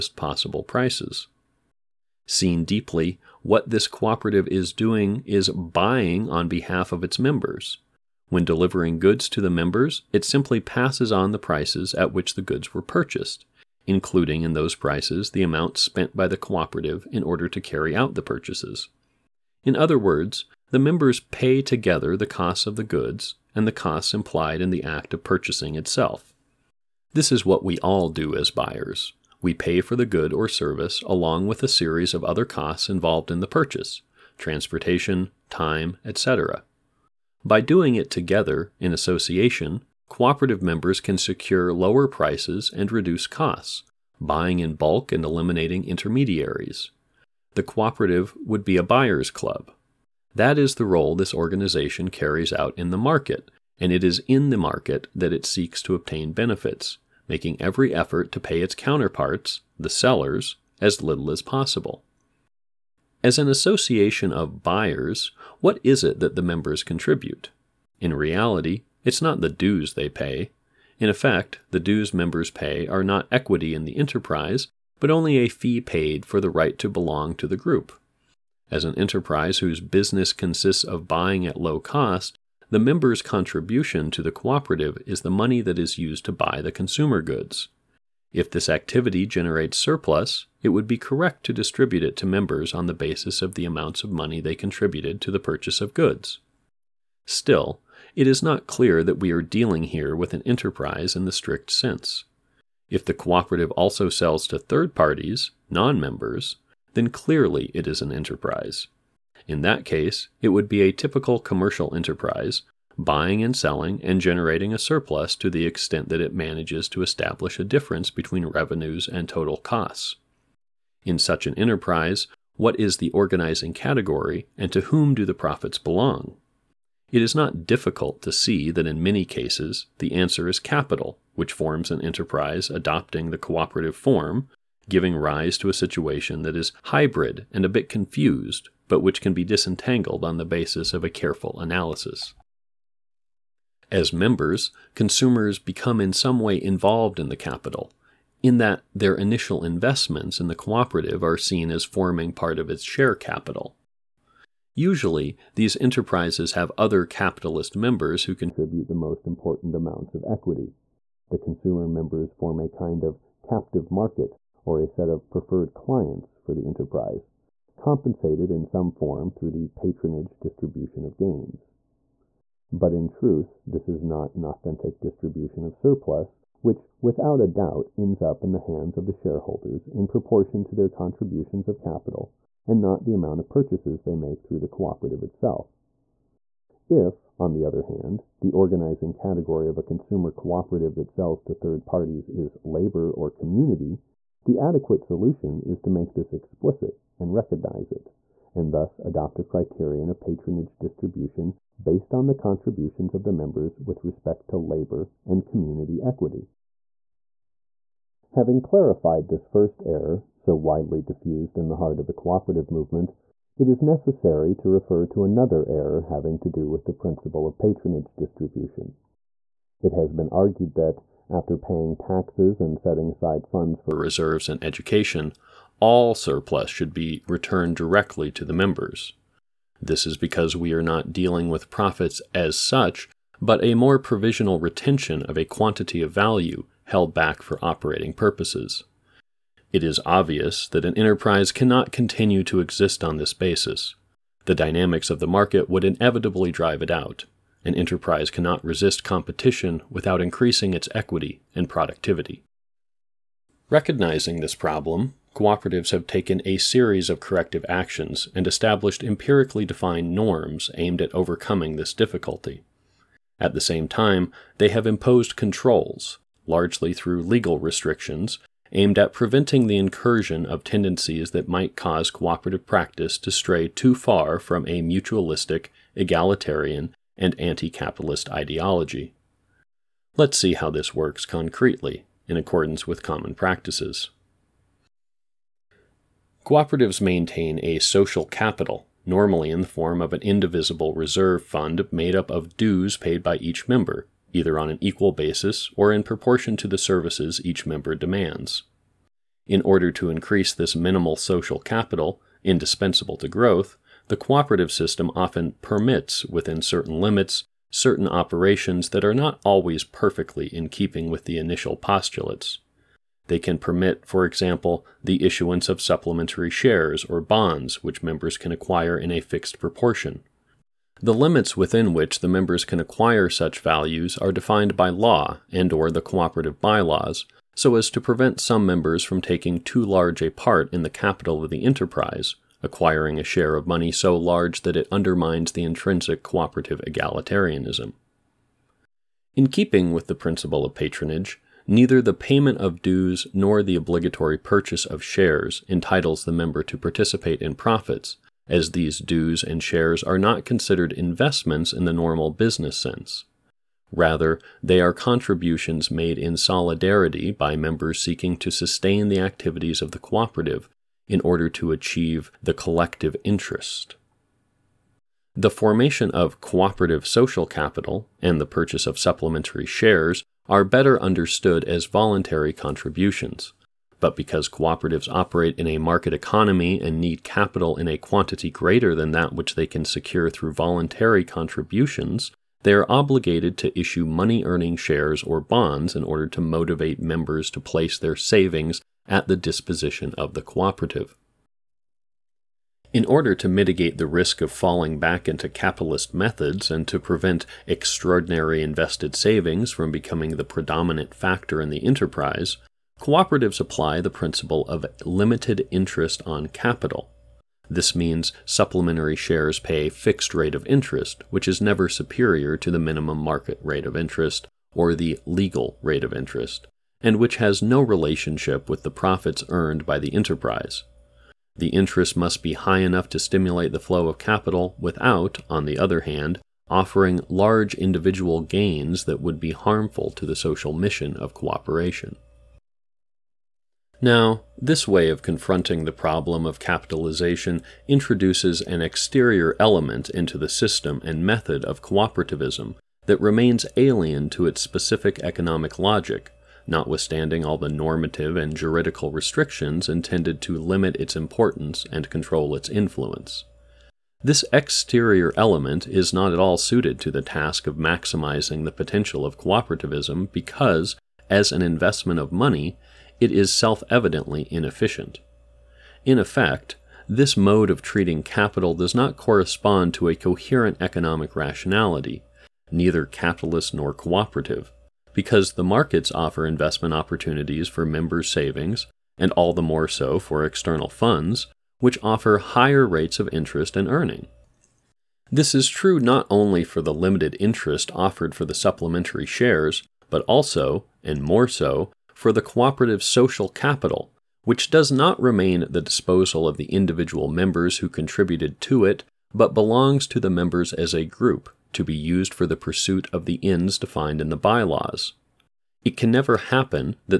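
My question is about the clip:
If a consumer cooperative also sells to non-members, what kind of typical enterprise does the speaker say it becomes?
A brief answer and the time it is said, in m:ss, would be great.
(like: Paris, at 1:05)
Commercial enterprise, at 1:50.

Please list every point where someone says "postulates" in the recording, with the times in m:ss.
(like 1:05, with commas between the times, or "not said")
5:11.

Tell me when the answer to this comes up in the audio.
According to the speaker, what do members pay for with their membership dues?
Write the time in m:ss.
1:16.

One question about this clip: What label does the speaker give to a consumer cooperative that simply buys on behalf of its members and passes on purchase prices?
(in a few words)
A buyer's club.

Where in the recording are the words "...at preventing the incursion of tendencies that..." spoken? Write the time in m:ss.
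4:28.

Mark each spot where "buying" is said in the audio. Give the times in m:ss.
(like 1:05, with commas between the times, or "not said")
0:05, 0:44, 1:21, 1:52.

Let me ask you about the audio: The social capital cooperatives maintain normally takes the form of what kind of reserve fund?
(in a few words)
Indivisible reserve fund.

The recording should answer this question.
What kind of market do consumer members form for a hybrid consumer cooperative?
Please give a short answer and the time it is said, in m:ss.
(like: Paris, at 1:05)
Captive market, at 2:43.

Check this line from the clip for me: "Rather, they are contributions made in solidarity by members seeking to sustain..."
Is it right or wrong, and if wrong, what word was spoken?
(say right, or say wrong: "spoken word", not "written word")
right.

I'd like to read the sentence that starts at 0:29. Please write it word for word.
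We pay for the good or service along with a series of other costs involved in the purchase transportation, time, etc.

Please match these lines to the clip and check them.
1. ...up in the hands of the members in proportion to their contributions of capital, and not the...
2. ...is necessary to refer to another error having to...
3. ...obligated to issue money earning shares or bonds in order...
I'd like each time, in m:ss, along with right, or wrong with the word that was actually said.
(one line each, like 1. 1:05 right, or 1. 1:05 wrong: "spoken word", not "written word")
1. 2:58 wrong: "shareholders", not "members"
2. 3:33 right
3. 6:22 right.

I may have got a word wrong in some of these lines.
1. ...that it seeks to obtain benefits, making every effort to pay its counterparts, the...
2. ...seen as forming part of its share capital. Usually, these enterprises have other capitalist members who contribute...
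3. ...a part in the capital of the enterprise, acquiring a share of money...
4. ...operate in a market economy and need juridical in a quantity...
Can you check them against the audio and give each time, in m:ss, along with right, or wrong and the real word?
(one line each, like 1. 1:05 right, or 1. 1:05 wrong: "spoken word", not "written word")
1. 0:55 right
2. 2:31 right
3. 5:30 right
4. 6:15 wrong: "capital", not "juridical".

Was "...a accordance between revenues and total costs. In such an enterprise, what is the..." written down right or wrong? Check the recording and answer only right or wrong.
wrong.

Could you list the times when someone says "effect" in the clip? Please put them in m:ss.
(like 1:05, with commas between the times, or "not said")
1:11, 7:46.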